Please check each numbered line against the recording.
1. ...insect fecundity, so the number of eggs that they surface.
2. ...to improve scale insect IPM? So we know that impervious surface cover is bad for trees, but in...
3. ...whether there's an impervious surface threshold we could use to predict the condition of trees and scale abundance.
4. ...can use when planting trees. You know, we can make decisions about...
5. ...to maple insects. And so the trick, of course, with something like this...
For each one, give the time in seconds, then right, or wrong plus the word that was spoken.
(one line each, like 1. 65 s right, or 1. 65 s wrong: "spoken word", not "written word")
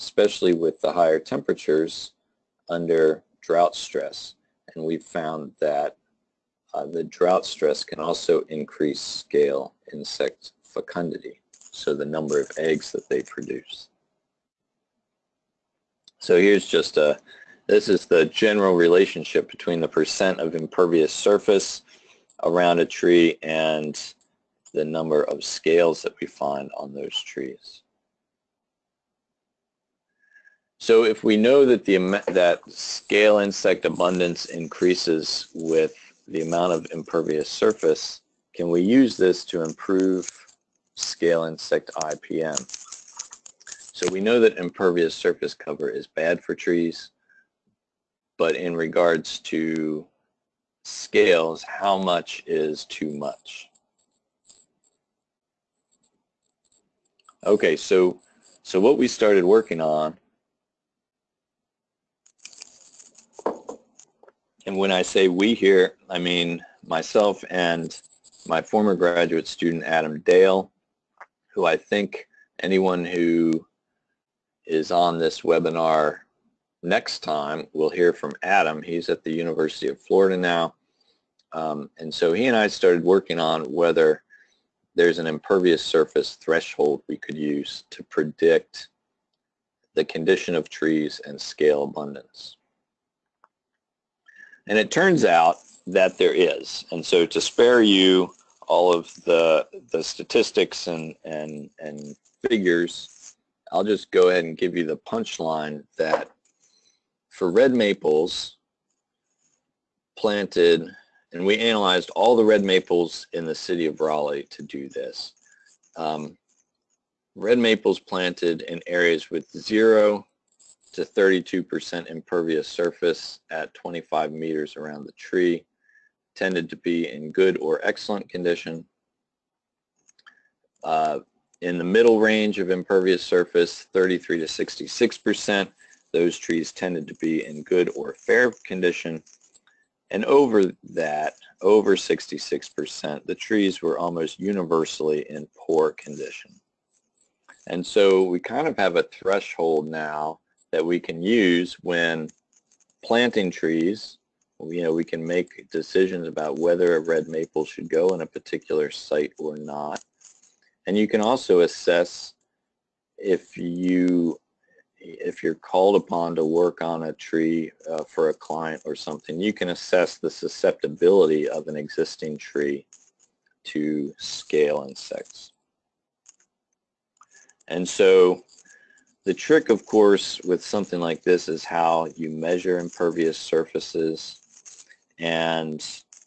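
1. 9 s wrong: "produce", not "surface"
2. 39 s right
3. 83 s right
4. 150 s right
5. 173 s wrong: "scale", not "maple".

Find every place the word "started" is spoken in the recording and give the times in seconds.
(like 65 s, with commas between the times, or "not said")
59 s, 82 s.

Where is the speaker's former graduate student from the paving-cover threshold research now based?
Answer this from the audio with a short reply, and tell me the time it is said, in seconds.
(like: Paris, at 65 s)
University of Florida, at 79 s.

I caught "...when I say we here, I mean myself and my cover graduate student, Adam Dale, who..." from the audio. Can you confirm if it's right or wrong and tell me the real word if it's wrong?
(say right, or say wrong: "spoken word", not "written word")
wrong: "former", not "cover".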